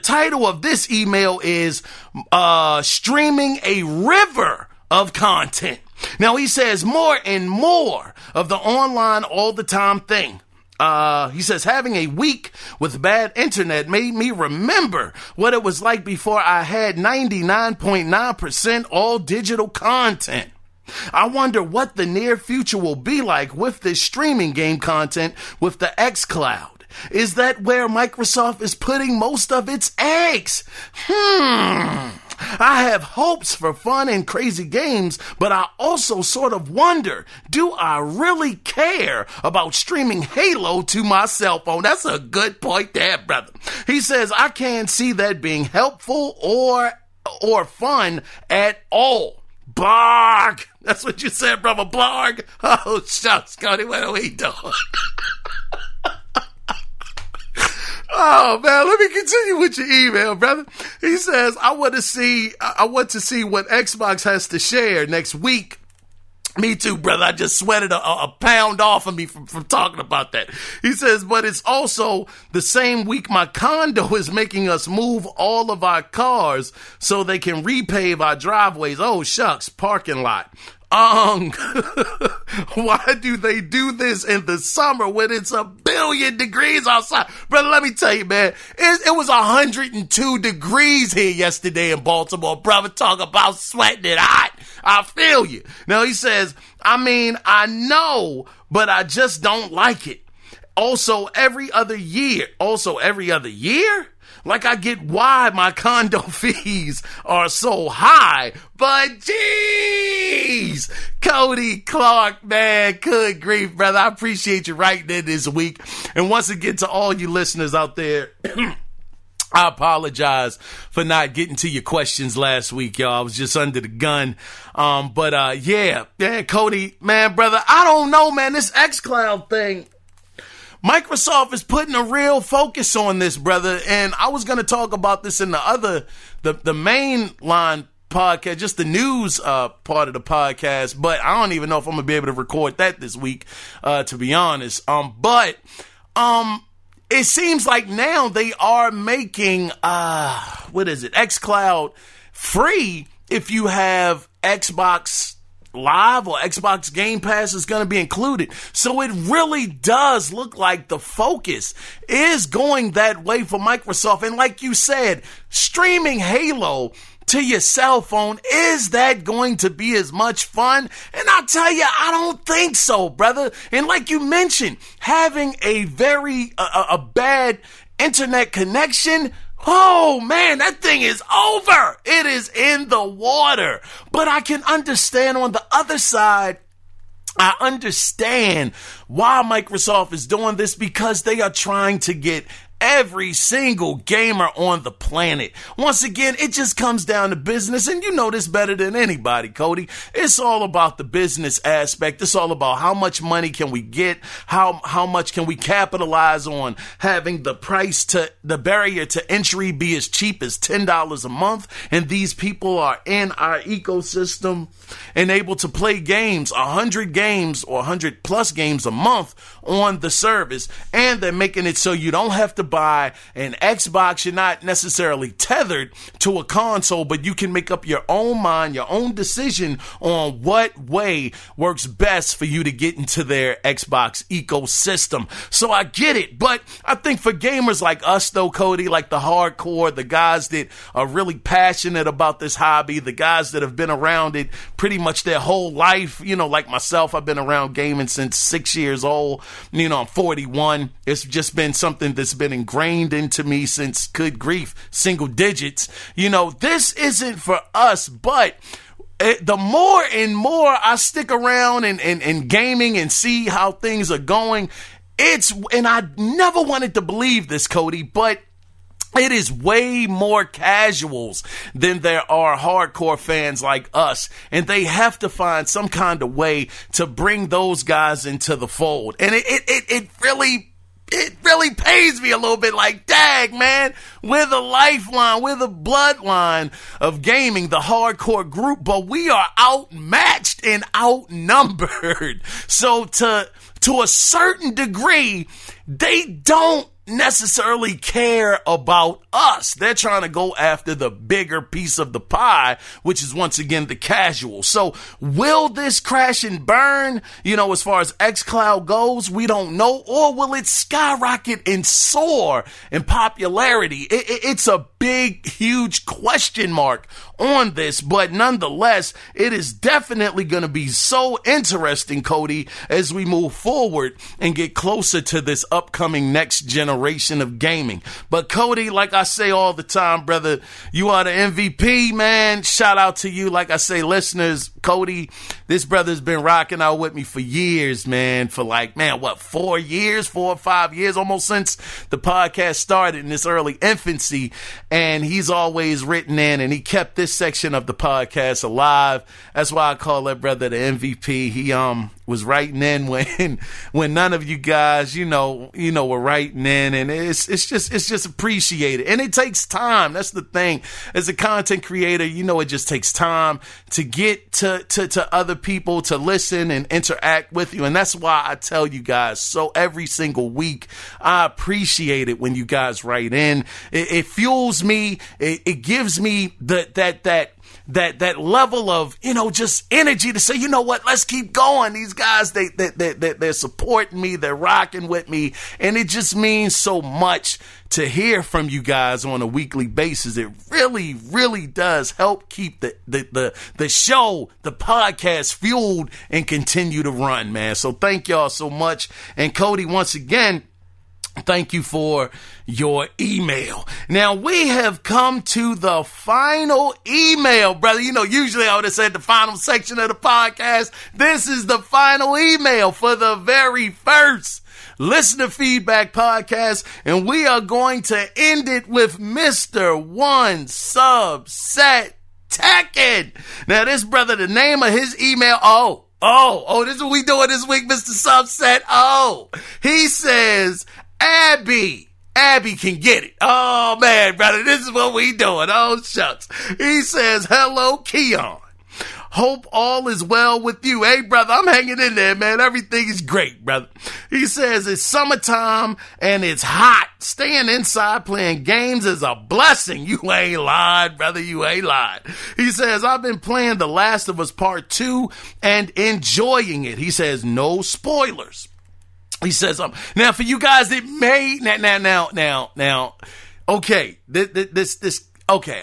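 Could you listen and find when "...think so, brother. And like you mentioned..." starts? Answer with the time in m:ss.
2:52.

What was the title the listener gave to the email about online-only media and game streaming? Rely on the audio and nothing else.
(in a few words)
Streaming a River of Content.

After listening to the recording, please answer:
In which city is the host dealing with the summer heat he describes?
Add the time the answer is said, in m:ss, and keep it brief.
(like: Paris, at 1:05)
Baltimore, at 1:32.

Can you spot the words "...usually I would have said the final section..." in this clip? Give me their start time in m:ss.
6:48.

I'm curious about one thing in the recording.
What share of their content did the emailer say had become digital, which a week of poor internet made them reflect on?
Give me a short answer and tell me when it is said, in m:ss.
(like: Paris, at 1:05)
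99.9%, at 0:16.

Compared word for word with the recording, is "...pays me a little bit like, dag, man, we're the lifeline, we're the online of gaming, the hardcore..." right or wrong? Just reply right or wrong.
wrong.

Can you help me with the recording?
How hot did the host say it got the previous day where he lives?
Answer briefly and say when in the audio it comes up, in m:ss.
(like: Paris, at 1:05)
102 degrees, at 1:29.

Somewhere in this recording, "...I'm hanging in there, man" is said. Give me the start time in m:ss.
7:21.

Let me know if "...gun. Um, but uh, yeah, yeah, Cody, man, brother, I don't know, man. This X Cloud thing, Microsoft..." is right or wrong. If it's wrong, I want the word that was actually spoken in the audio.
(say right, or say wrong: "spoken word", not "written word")
right.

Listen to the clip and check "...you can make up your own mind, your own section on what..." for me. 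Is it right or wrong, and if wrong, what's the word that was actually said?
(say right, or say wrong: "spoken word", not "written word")
wrong: "decision", not "section".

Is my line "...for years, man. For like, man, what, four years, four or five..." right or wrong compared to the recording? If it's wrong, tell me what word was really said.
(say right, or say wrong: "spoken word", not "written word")
right.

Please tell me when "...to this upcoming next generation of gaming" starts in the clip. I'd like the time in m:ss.
5:25.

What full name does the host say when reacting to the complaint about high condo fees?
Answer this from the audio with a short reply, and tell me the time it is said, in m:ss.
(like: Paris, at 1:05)
Cody Clark, at 1:51.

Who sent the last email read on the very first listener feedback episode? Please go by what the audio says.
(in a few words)
One Subset Tekken.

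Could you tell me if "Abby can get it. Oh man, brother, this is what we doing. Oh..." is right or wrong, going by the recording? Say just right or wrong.
right.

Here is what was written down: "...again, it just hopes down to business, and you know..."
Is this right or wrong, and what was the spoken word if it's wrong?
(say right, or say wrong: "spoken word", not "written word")
wrong: "comes", not "hopes".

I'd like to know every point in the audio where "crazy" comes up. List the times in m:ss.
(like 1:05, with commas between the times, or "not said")
0:34.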